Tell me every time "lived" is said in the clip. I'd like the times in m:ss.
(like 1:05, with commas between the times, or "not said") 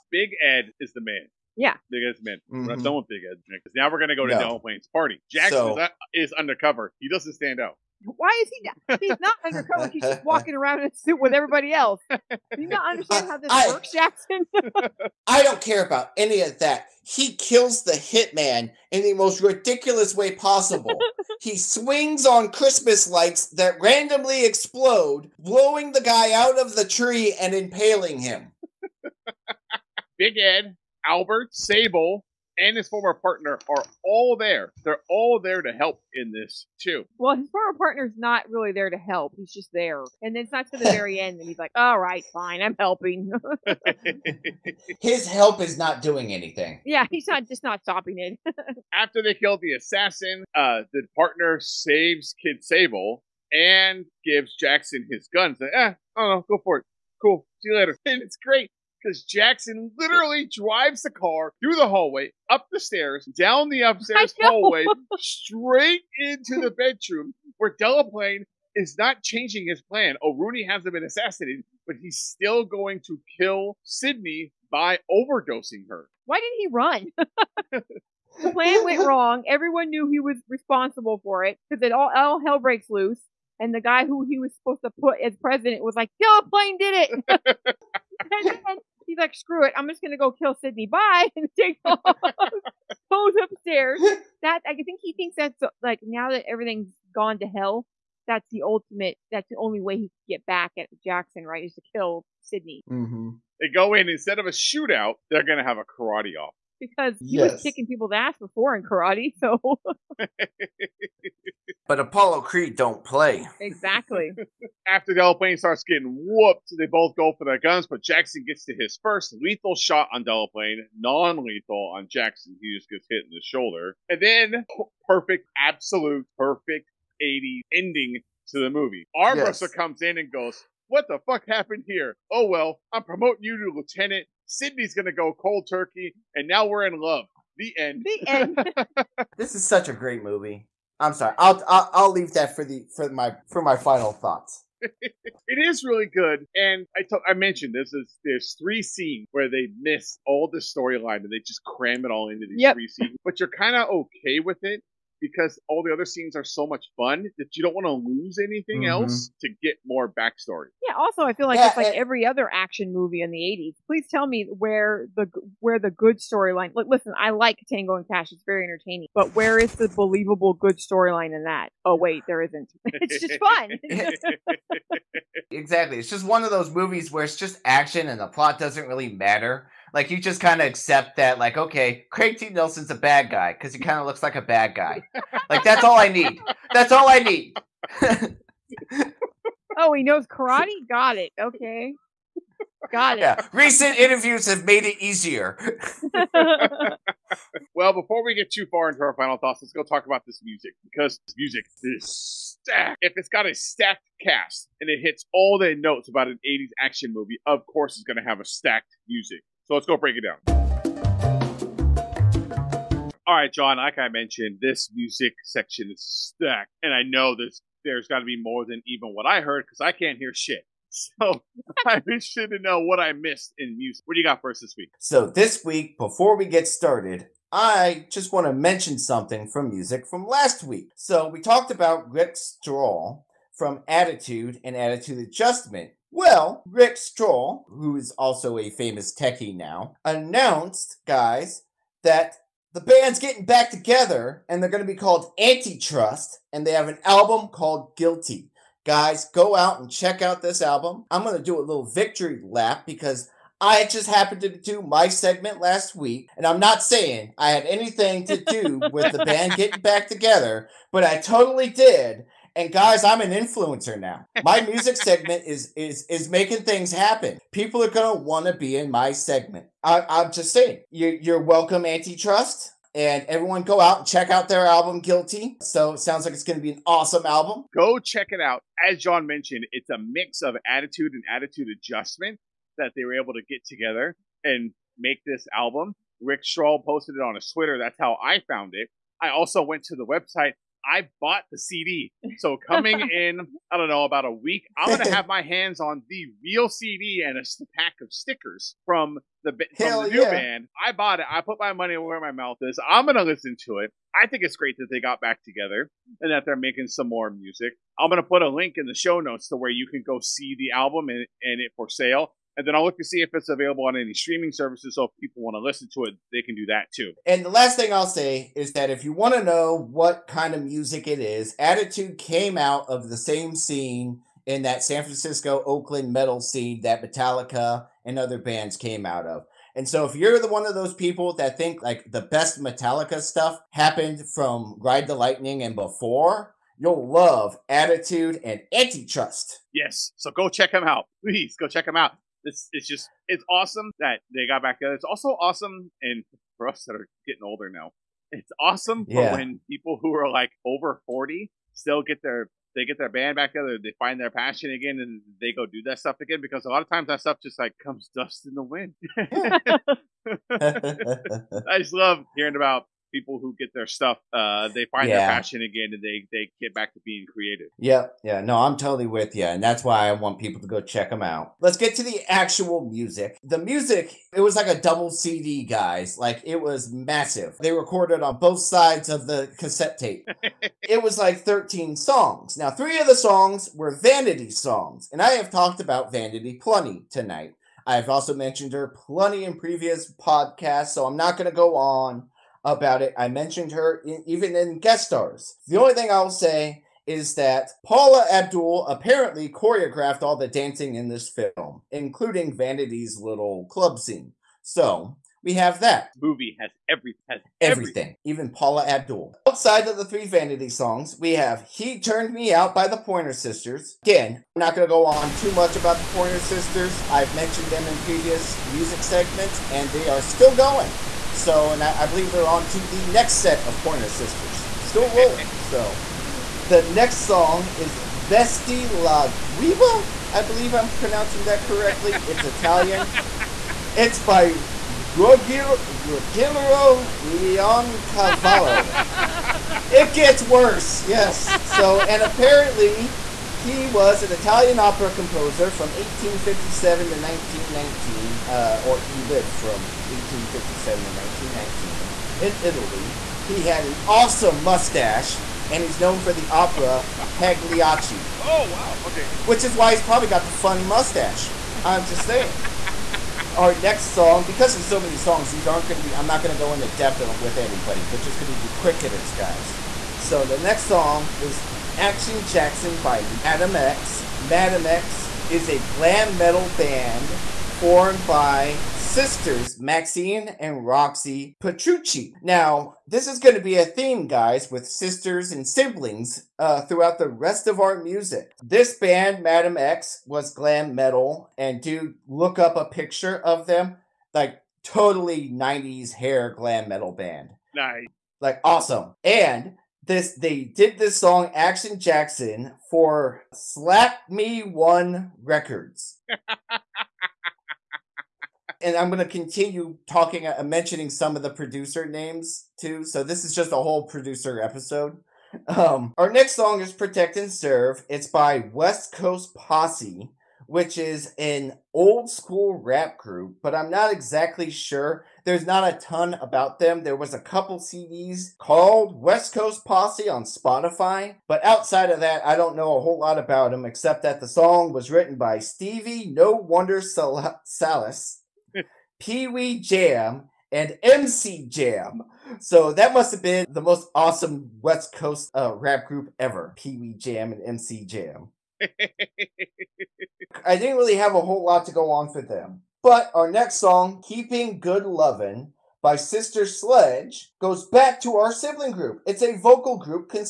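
7:29.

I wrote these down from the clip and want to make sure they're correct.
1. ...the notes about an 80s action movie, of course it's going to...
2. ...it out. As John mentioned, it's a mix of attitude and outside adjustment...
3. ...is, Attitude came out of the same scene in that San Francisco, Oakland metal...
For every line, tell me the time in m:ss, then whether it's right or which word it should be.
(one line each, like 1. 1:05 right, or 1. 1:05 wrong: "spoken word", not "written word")
1. 3:25 right
2. 4:38 wrong: "attitude", not "outside"
3. 5:21 right.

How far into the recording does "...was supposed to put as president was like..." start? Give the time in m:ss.
1:24.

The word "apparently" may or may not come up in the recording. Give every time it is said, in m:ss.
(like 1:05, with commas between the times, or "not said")
6:38, 7:22.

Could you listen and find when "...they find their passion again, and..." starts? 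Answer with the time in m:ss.
5:53.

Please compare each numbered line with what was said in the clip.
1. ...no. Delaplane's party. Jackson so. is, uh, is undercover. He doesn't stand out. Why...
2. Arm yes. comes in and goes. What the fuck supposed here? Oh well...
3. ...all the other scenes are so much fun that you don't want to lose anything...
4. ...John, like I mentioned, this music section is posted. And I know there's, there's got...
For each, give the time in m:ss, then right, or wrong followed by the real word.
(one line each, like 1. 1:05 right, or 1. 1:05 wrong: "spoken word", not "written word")
1. 0:04 right
2. 2:09 wrong: "happened", not "supposed"
3. 2:35 right
4. 3:33 wrong: "stacked", not "posted".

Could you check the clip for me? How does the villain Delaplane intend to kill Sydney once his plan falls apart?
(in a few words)
By overdosing her.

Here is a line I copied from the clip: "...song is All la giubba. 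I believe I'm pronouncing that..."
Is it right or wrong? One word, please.
wrong.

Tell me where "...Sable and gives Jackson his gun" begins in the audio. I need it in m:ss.
0:52.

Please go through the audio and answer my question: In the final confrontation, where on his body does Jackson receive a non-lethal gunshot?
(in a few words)
The shoulder.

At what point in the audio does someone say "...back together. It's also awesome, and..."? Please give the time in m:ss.
5:44.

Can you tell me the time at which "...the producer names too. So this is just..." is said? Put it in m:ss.
8:31.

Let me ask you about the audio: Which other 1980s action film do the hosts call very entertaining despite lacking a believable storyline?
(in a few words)
Tango and Cash.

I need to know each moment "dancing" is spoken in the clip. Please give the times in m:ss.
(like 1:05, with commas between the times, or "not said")
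6:40.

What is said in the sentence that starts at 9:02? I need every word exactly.
So that must have been the most awesome West Coast uh, rap group ever Pee Wee Jam and MC Jam.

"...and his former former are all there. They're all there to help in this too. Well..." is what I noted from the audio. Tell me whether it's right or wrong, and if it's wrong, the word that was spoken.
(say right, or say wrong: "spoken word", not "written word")
wrong: "partner", not "former".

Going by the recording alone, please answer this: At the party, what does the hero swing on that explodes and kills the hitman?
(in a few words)
Christmas lights.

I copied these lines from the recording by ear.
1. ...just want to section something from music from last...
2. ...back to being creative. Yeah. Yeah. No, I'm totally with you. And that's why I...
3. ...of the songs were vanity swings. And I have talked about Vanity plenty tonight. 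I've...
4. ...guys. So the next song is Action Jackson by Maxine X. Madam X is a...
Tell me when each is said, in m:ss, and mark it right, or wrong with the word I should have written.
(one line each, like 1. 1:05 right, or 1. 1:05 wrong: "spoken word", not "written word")
1. 3:48 wrong: "mention", not "section"
2. 6:06 right
3. 6:22 wrong: "songs", not "swings"
4. 7:49 wrong: "Madam", not "Maxine".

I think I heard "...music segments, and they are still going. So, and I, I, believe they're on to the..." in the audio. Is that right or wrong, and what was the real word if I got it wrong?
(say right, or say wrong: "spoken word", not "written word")
right.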